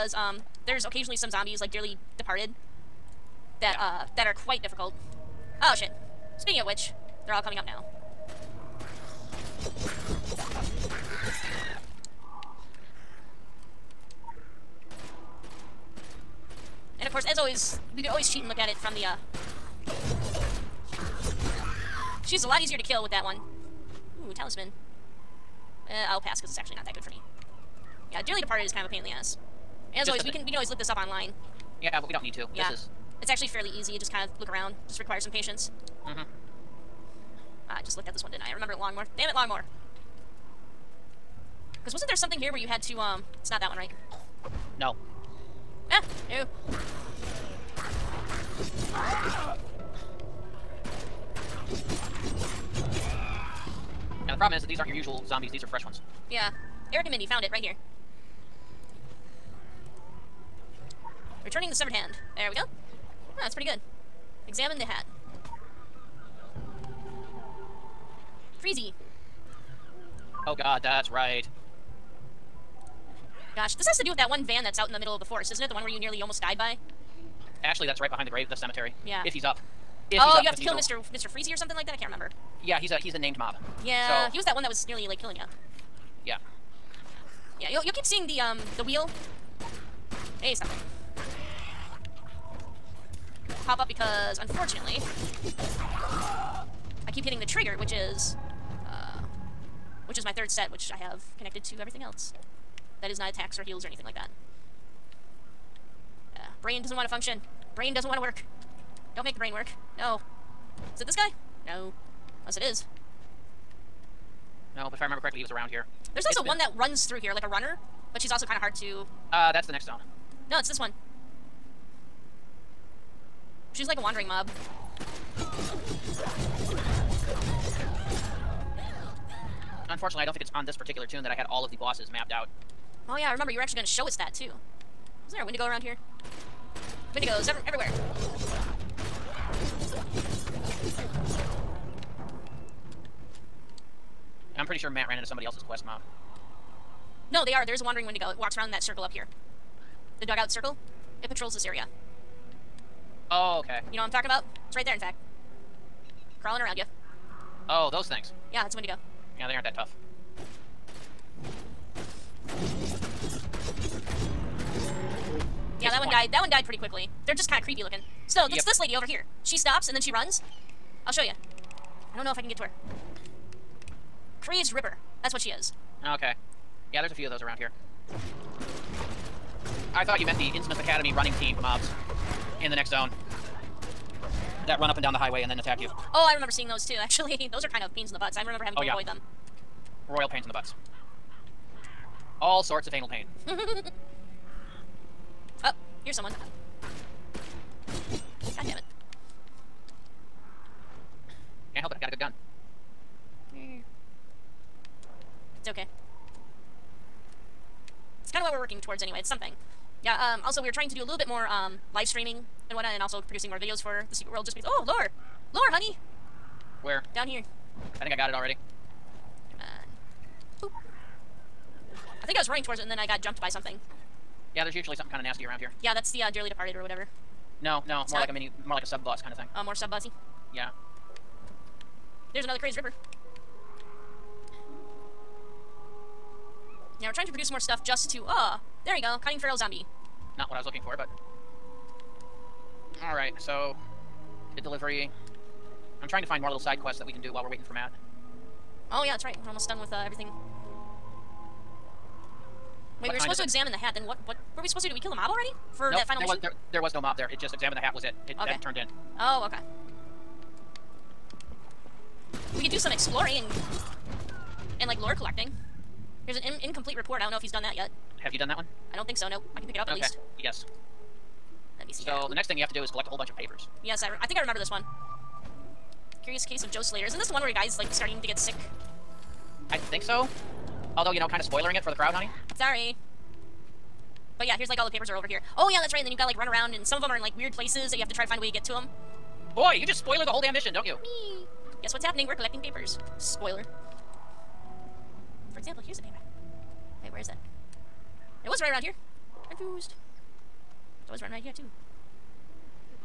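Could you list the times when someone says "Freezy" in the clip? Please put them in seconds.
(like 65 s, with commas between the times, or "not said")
68 s, 81 s.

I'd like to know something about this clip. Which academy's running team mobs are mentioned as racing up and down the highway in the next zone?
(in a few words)
Innsmouth Academy.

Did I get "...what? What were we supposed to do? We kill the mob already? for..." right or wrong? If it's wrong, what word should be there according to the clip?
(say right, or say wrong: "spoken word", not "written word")
right.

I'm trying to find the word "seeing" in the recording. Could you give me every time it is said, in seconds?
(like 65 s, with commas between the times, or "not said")
88 s, 186 s.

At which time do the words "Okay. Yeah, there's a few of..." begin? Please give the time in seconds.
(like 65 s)
176 s.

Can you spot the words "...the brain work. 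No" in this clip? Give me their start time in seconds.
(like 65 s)
109 s.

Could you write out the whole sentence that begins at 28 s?
Yeah, Dearly Departed is kind of a pain in the ass.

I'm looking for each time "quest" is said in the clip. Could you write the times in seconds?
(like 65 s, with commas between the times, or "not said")
145 s, 246 s.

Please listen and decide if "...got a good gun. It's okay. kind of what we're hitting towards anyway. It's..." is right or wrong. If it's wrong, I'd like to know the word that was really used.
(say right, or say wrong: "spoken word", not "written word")
wrong: "working", not "hitting".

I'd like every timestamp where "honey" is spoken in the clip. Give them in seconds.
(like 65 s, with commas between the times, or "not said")
215 s, 282 s.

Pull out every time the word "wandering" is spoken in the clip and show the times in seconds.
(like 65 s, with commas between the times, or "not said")
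124 s, 147 s.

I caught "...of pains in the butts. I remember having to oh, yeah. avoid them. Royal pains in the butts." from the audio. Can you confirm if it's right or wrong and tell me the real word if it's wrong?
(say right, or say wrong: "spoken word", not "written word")
right.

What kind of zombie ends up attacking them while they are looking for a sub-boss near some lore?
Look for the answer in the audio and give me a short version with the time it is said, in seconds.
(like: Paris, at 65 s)
cunning feral zombie, at 239 s.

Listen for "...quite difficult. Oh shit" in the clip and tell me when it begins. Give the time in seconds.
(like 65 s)
4 s.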